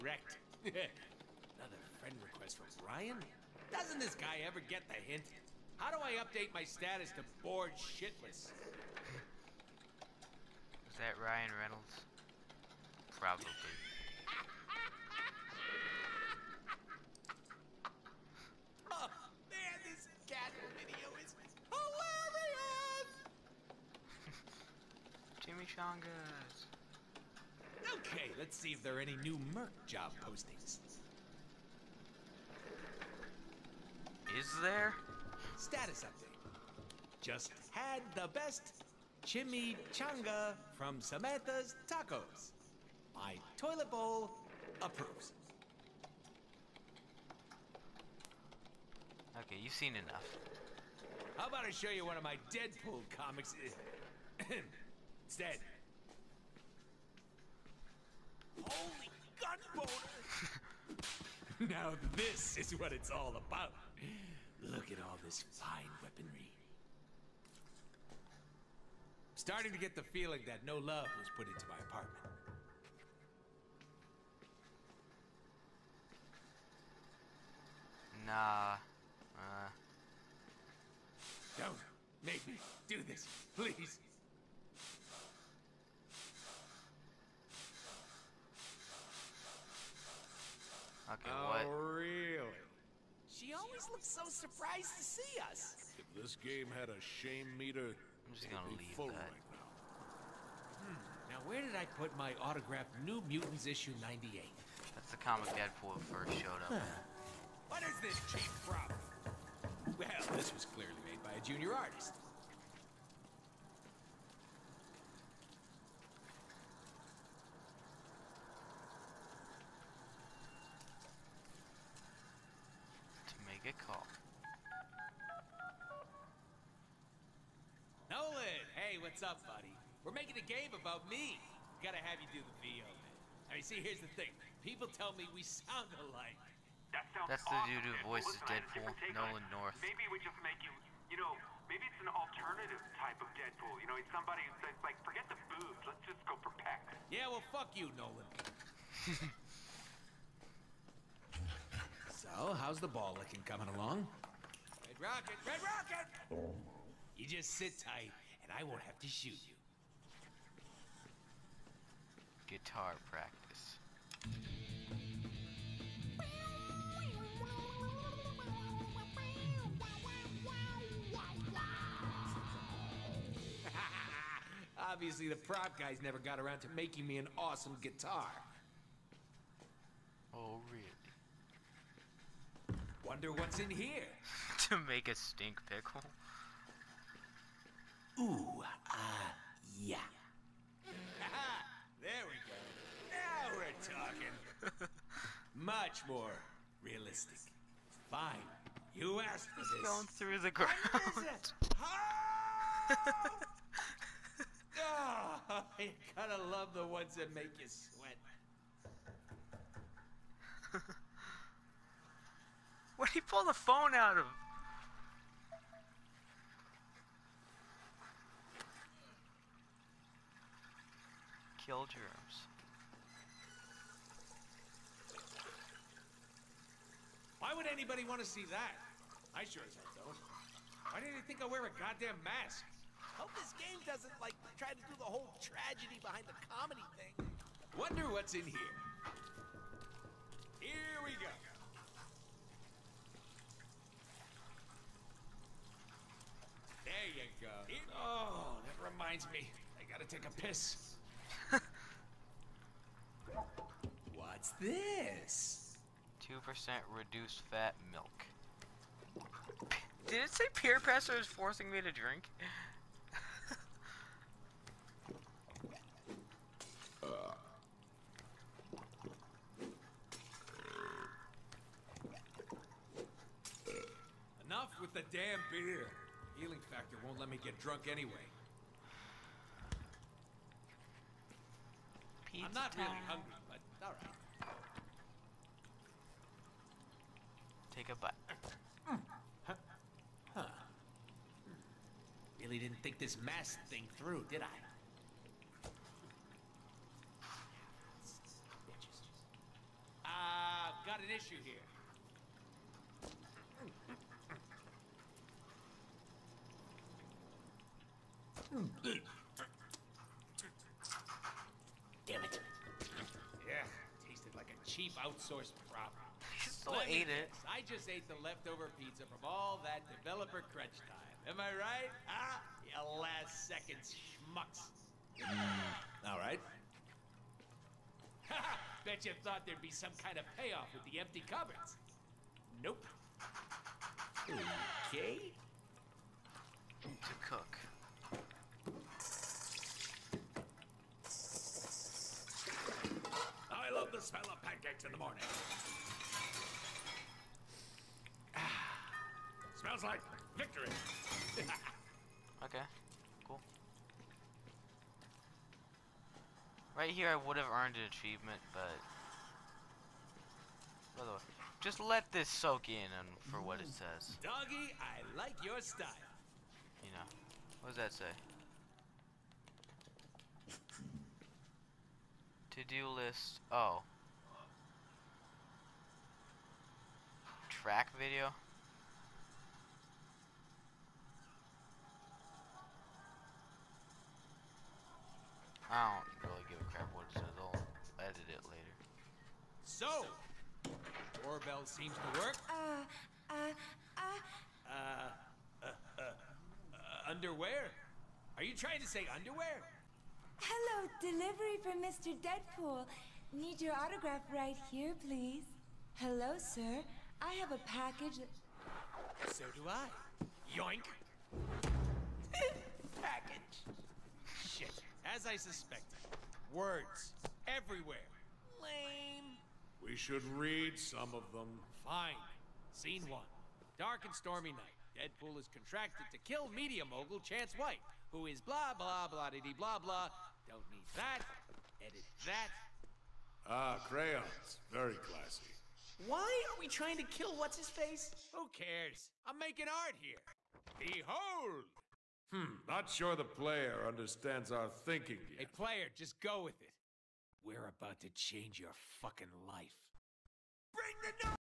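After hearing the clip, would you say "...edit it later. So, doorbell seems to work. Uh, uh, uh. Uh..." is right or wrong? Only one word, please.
right.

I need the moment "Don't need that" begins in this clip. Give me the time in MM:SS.
07:10.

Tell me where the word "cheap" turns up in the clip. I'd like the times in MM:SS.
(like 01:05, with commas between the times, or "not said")
01:48, 05:14.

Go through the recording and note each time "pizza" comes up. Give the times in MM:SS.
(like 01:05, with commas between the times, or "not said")
04:42, 05:18.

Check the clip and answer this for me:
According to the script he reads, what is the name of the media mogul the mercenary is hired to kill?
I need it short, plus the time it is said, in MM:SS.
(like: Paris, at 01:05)
Chance White, at 07:07.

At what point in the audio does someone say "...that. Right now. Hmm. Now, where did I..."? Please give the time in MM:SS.
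01:38.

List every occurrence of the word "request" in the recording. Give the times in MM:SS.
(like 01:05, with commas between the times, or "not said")
00:02.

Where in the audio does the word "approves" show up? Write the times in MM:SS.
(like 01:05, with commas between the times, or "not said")
00:44.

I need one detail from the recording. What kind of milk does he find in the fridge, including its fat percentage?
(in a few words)
2% reduced fat milk.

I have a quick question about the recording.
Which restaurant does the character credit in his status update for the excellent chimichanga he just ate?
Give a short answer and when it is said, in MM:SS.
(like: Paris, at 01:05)
Samantha's Tacos, at 00:40.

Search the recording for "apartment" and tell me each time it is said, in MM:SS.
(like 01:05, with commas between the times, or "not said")
01:11.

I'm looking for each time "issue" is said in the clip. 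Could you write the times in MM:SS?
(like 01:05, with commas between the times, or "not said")
01:43, 05:01.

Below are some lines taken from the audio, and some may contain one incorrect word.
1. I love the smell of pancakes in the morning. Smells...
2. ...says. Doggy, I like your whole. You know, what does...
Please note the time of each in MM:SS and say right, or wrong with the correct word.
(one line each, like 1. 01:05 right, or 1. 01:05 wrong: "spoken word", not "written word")
1. 05:43 right
2. 06:03 wrong: "style", not "whole".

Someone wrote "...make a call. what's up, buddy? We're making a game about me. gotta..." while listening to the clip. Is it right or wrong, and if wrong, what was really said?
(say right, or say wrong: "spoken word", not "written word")
right.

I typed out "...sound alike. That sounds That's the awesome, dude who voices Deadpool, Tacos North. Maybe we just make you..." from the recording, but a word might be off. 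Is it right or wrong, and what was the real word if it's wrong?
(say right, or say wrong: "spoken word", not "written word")
wrong: "Nolan", not "Tacos".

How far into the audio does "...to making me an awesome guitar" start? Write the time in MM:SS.
02:56.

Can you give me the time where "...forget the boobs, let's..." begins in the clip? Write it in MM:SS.
02:25.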